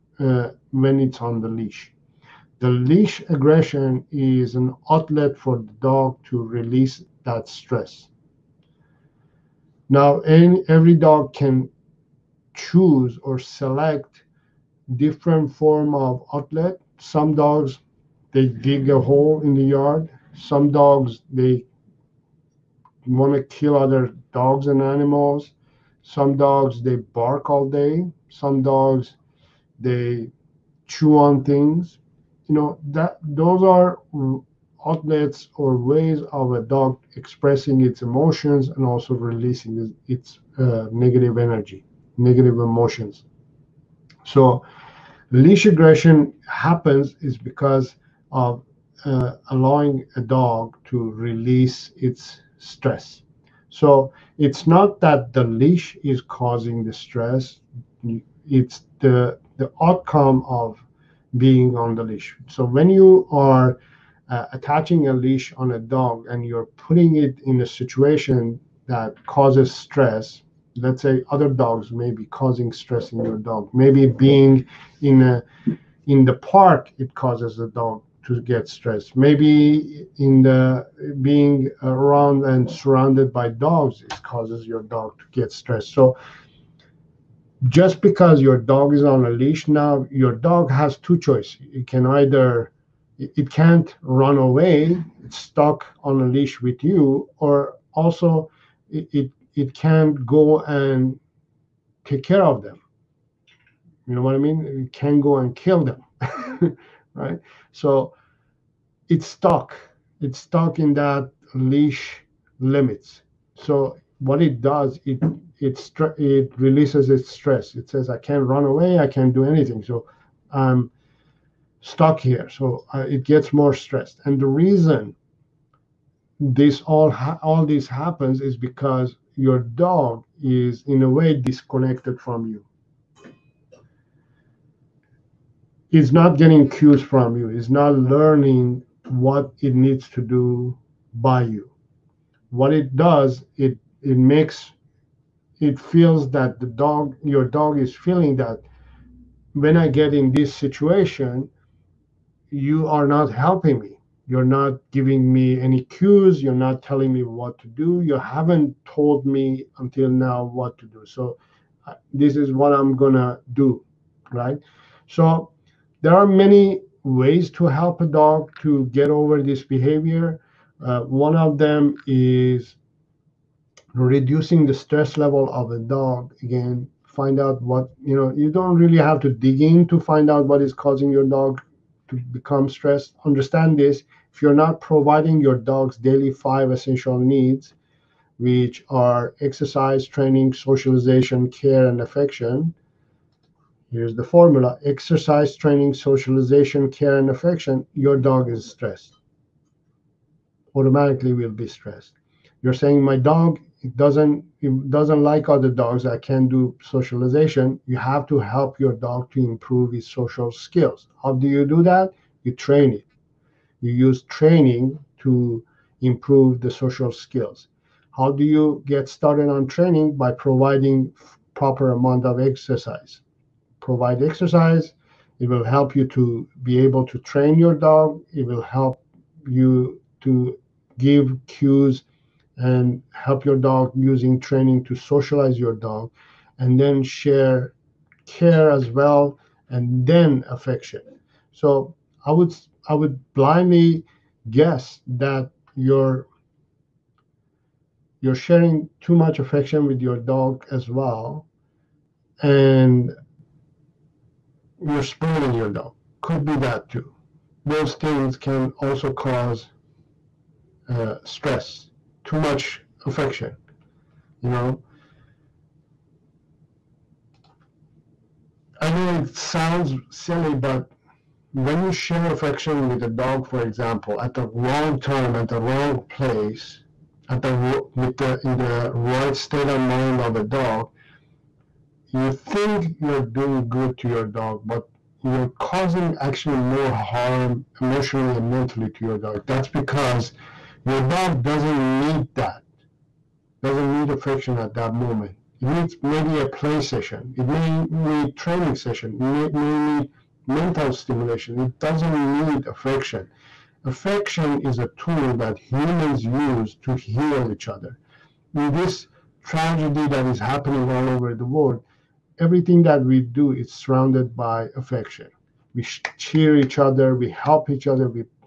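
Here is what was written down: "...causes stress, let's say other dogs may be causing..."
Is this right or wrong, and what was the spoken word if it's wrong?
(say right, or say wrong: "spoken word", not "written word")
right.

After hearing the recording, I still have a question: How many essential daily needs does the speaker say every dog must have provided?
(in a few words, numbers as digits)
5.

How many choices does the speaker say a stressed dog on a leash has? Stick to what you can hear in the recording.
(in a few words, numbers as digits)
2.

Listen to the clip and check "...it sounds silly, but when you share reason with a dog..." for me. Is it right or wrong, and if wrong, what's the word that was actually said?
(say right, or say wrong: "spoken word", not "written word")
wrong: "affection", not "reason".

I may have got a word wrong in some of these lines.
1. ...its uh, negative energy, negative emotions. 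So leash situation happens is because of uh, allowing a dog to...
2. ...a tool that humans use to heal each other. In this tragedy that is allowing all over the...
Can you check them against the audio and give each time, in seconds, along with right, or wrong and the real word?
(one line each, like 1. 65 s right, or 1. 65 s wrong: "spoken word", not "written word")
1. 40 s wrong: "aggression", not "situation"
2. 304 s wrong: "happening", not "allowing".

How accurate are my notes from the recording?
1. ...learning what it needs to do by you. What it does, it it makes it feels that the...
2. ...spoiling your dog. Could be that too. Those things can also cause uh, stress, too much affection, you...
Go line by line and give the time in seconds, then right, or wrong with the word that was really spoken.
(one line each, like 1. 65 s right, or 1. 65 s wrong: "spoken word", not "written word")
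1. 137 s right
2. 255 s right.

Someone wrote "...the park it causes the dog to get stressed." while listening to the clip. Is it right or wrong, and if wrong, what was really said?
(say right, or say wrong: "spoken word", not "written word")
right.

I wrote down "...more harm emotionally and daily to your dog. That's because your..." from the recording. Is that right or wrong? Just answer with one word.
wrong.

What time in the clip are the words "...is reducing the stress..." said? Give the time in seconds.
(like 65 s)
172 s.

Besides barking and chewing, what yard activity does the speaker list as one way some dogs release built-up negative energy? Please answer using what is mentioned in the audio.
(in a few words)
dig a hole.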